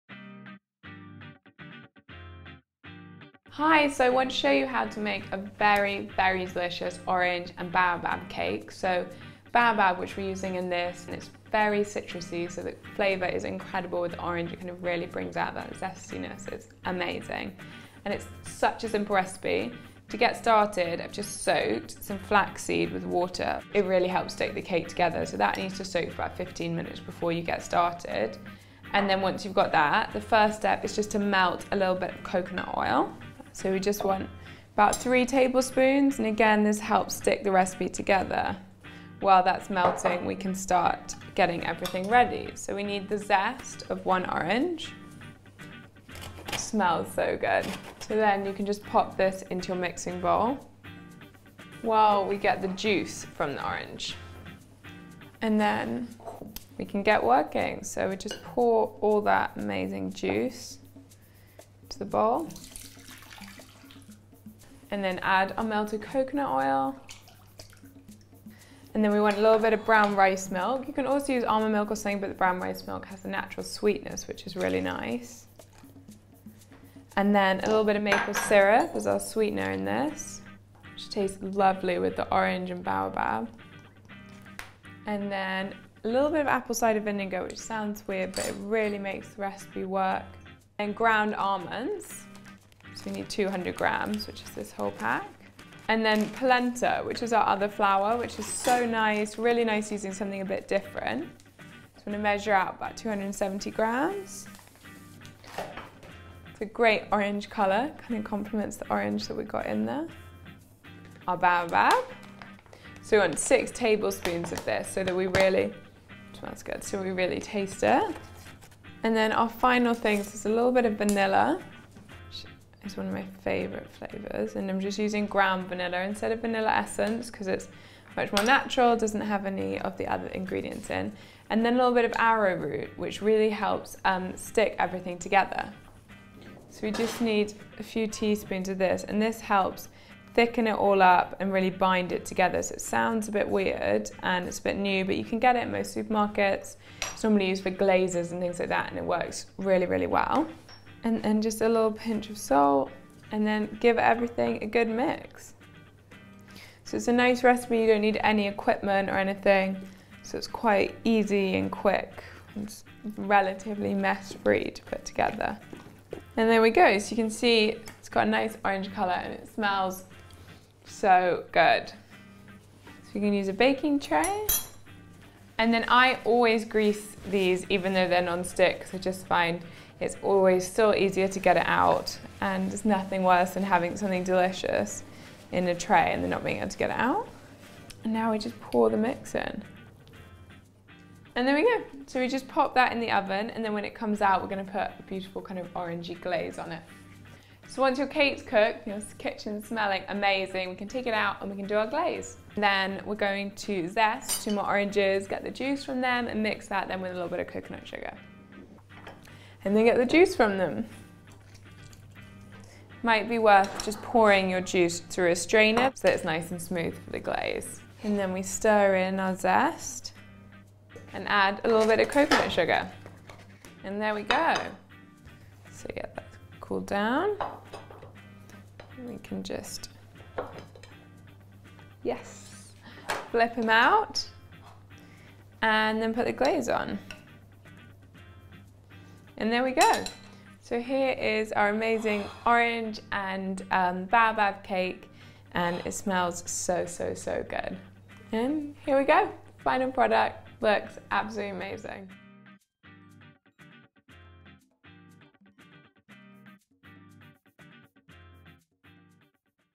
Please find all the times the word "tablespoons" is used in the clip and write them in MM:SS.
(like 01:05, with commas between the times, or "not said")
00:35, 01:53.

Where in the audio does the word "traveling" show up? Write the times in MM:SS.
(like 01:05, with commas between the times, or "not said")
not said.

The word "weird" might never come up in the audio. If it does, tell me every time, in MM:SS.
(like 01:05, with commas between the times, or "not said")
01:28, 02:23.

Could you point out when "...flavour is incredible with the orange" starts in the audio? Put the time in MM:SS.
00:12.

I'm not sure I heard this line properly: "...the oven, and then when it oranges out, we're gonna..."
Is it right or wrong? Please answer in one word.
wrong.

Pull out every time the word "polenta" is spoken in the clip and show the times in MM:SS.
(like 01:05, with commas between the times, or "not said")
01:36.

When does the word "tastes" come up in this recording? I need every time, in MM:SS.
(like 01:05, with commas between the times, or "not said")
01:21, 01:57.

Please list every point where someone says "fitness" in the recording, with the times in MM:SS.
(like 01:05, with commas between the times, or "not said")
not said.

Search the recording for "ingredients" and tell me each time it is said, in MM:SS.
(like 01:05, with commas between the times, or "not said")
02:10.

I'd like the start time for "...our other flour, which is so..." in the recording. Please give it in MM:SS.
01:37.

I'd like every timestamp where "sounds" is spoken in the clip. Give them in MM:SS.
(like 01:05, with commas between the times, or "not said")
01:27, 02:22.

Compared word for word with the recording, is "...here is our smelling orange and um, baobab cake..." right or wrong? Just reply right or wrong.
wrong.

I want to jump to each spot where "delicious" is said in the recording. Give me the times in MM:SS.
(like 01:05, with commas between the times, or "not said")
00:06, 03:04.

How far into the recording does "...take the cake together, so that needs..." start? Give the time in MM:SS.
00:24.